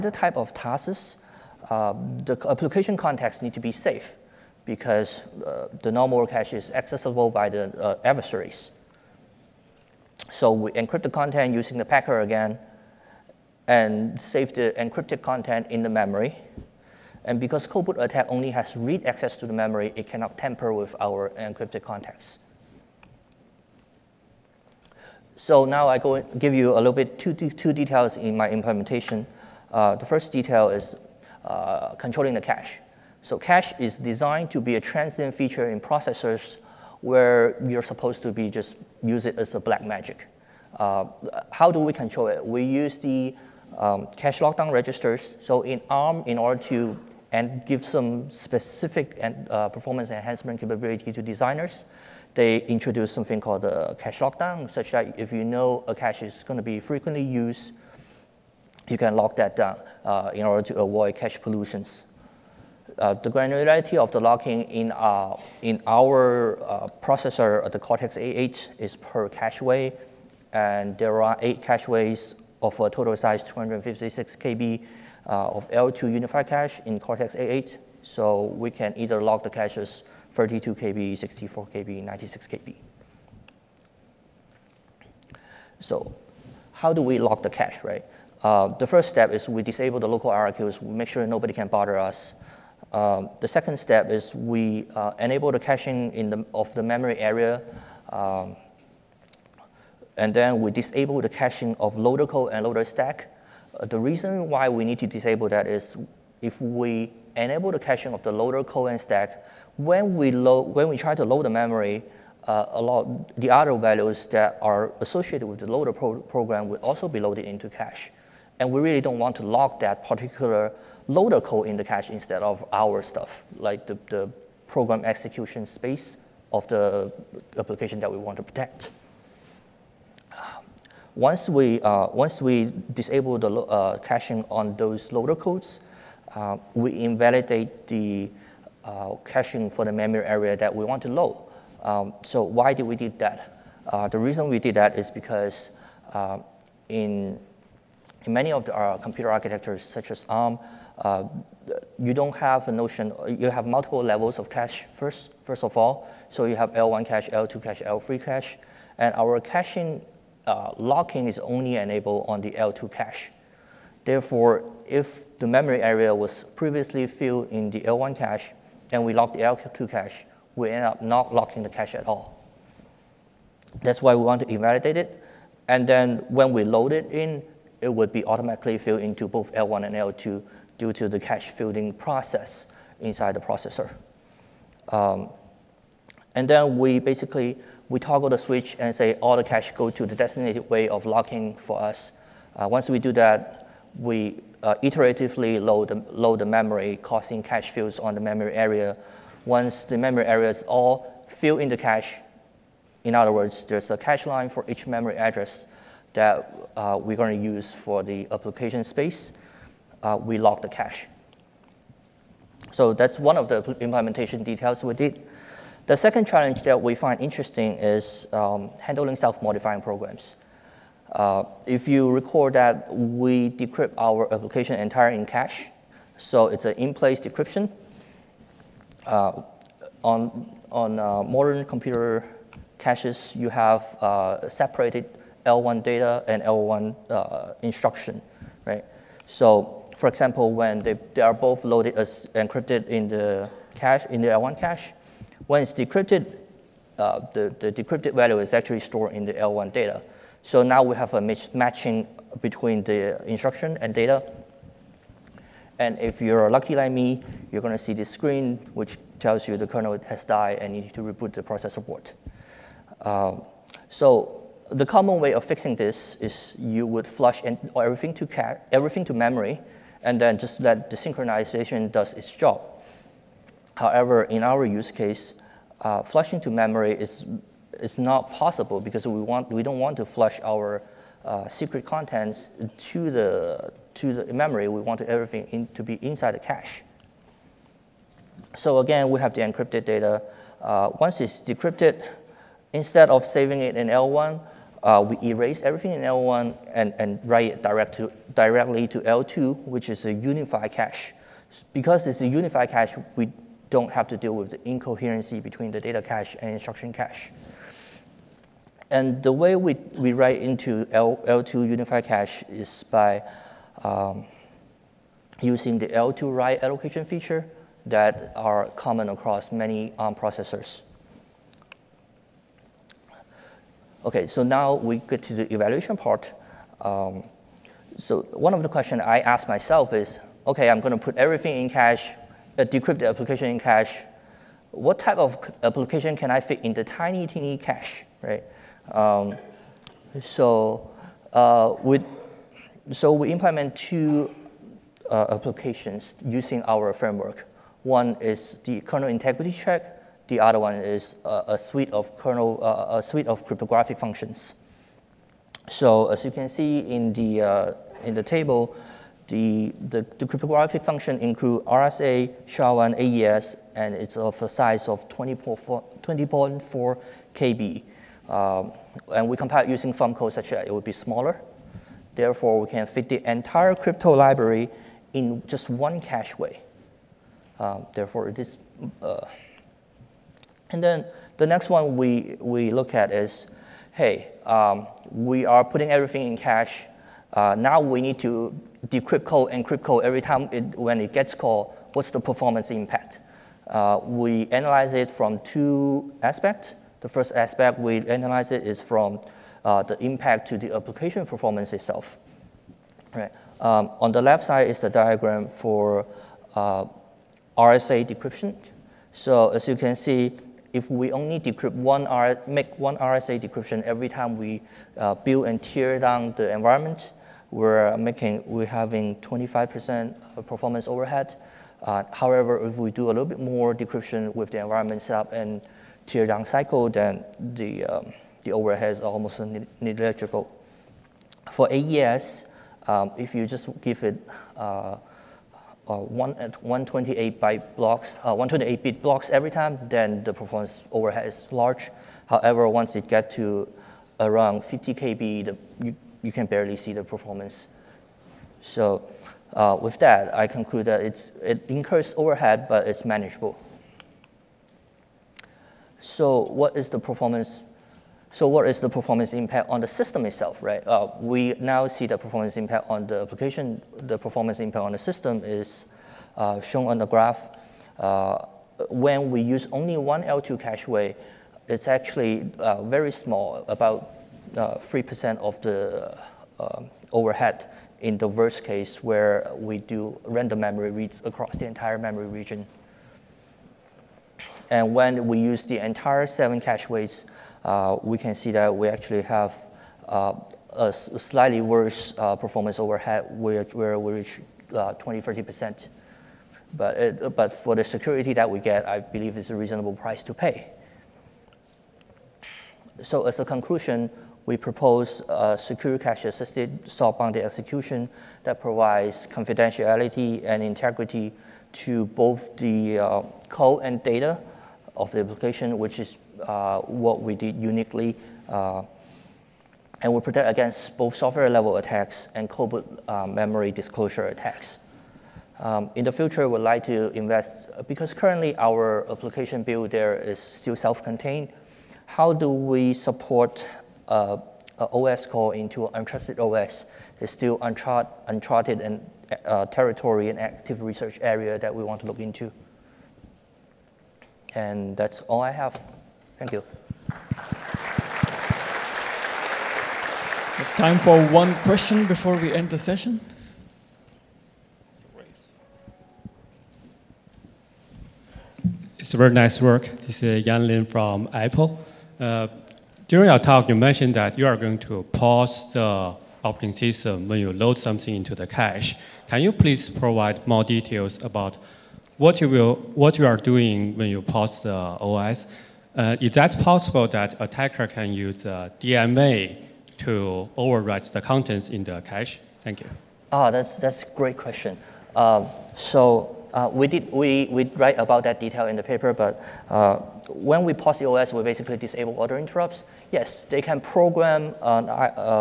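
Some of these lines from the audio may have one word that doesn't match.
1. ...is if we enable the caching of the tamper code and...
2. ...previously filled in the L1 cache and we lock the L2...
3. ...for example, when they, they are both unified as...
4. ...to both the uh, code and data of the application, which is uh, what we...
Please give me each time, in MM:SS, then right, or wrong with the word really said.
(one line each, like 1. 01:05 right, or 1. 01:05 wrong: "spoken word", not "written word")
1. 01:45 wrong: "loader", not "tamper"
2. 02:46 right
3. 03:59 wrong: "loaded", not "unified"
4. 08:31 right.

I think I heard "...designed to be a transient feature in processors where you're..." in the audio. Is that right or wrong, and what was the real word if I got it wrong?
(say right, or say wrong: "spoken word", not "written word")
right.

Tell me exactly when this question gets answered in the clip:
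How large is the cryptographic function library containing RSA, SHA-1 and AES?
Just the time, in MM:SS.
06:05.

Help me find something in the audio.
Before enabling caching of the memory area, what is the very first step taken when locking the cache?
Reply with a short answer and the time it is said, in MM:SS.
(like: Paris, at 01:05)
Disable the local IRQs, at 01:29.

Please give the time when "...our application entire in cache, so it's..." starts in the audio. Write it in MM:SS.
03:43.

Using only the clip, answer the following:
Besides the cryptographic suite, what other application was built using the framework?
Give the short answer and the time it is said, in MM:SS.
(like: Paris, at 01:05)
Kernel integrity check, at 05:48.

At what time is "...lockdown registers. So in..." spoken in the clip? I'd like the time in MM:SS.
00:44.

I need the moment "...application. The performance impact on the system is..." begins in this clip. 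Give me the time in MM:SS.
07:43.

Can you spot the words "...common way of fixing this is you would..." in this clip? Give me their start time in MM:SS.
04:24.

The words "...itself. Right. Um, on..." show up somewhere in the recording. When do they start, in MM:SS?
06:41.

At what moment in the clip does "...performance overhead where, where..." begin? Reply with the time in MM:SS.
08:12.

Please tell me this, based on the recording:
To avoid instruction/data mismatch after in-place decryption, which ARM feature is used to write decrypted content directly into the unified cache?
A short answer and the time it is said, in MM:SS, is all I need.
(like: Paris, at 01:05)
L2 write allocation, at 05:15.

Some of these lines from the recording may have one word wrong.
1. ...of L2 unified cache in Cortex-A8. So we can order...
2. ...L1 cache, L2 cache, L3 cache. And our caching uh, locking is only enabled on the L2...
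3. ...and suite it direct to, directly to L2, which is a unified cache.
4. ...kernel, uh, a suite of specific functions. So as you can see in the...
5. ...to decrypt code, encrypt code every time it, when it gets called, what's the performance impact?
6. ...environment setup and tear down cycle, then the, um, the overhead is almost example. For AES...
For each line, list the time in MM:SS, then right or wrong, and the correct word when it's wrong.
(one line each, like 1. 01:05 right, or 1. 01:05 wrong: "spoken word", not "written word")
1. 01:15 wrong: "either", not "order"
2. 02:36 right
3. 04:56 wrong: "write", not "suite"
4. 05:52 wrong: "cryptographic", not "specific"
5. 06:28 right
6. 07:04 wrong: "negligible", not "example".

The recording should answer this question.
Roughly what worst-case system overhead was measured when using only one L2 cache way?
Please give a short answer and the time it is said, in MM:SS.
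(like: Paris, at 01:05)
3%, at 07:54.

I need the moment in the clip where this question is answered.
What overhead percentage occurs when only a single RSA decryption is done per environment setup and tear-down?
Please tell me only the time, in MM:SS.
06:59.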